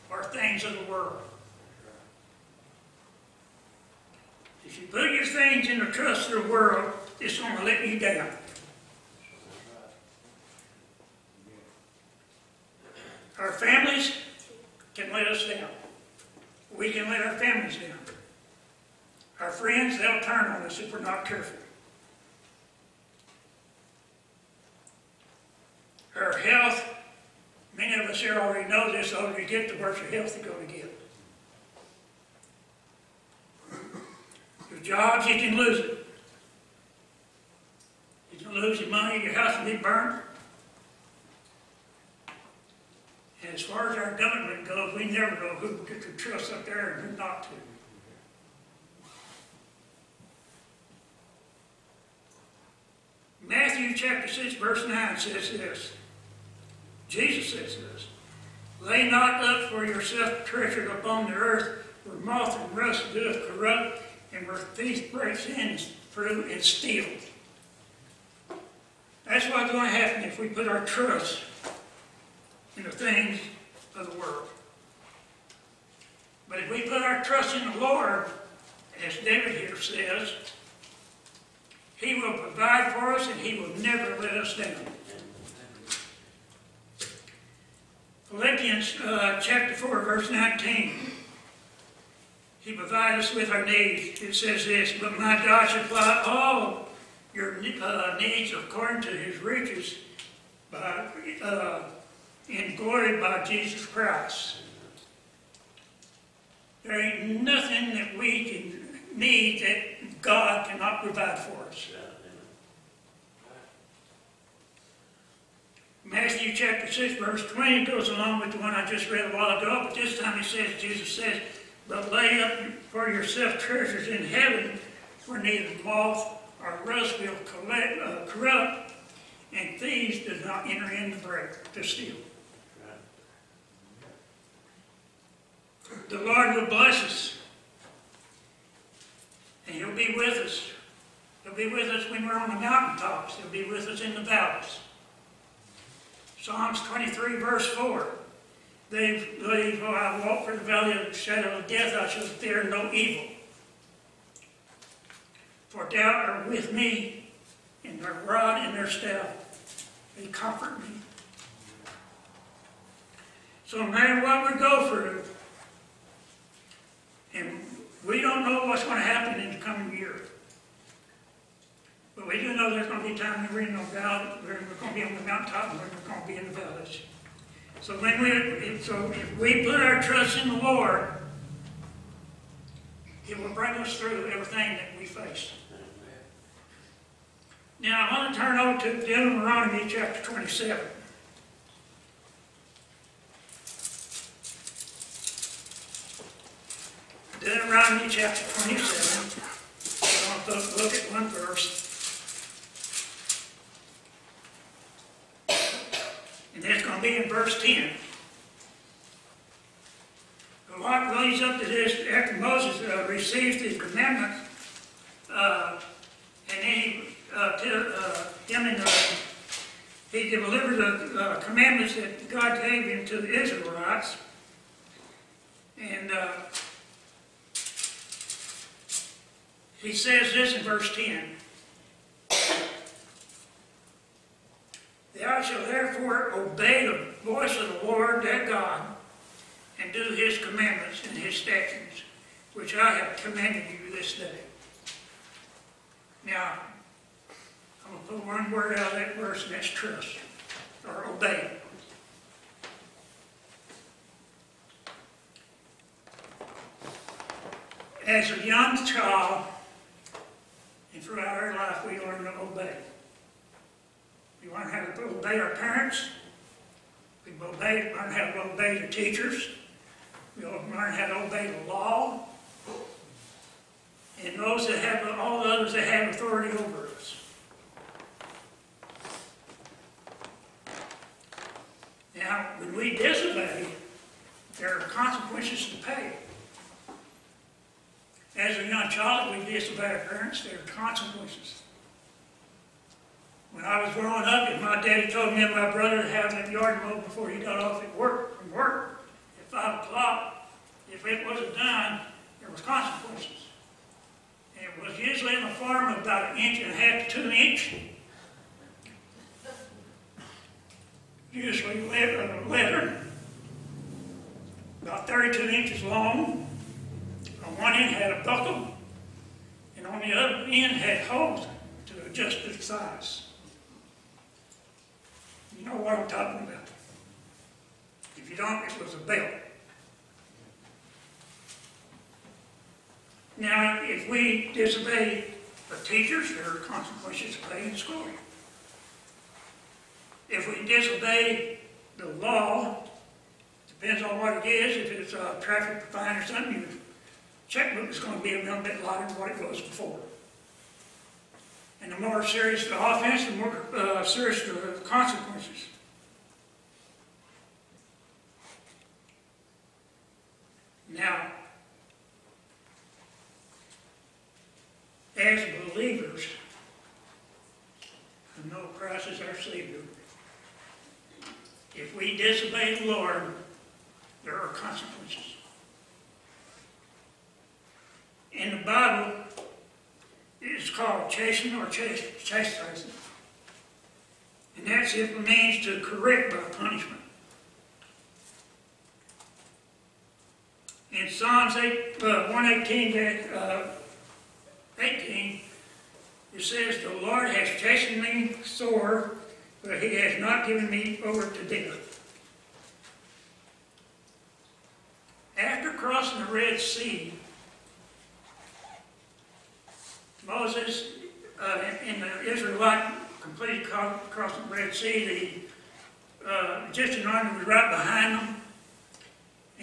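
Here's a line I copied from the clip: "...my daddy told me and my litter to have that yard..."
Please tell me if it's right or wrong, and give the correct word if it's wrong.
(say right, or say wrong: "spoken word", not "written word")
wrong: "brother", not "litter".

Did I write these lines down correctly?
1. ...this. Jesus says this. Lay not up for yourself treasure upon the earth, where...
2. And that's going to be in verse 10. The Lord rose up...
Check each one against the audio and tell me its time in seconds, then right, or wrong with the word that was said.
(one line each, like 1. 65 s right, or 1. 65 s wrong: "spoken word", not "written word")
1. 55 s right
2. 206 s right.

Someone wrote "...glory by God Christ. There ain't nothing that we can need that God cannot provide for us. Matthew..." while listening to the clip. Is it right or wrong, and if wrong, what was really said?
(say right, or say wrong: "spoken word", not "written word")
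wrong: "Jesus", not "God".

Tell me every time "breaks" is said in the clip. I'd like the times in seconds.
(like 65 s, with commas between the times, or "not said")
65 s, 131 s.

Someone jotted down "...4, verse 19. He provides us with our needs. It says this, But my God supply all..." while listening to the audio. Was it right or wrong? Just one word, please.
right.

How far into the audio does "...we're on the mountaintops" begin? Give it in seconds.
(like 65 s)
142 s.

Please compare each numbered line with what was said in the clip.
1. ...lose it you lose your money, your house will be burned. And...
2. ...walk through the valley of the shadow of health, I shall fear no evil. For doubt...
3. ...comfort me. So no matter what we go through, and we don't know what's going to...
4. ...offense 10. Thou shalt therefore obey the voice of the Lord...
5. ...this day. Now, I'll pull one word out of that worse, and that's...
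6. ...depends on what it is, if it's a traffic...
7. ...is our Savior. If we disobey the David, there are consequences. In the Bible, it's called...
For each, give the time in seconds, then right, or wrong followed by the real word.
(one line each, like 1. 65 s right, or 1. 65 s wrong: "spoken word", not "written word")
1. 35 s right
2. 150 s wrong: "death", not "health"
3. 160 s right
4. 230 s wrong: "verse", not "offense"
5. 243 s wrong: "verse", not "worse"
6. 343 s right
7. 369 s wrong: "Lord", not "David".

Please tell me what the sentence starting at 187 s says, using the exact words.
Now I want to turn over to Deuteronomy chapter 27.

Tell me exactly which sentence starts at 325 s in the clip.
You know what I'm talking about.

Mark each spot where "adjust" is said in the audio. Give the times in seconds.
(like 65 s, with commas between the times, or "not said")
322 s.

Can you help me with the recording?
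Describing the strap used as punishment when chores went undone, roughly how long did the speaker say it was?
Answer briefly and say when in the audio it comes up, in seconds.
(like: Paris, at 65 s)
32 inches, at 315 s.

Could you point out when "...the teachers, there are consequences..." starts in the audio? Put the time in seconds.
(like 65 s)
335 s.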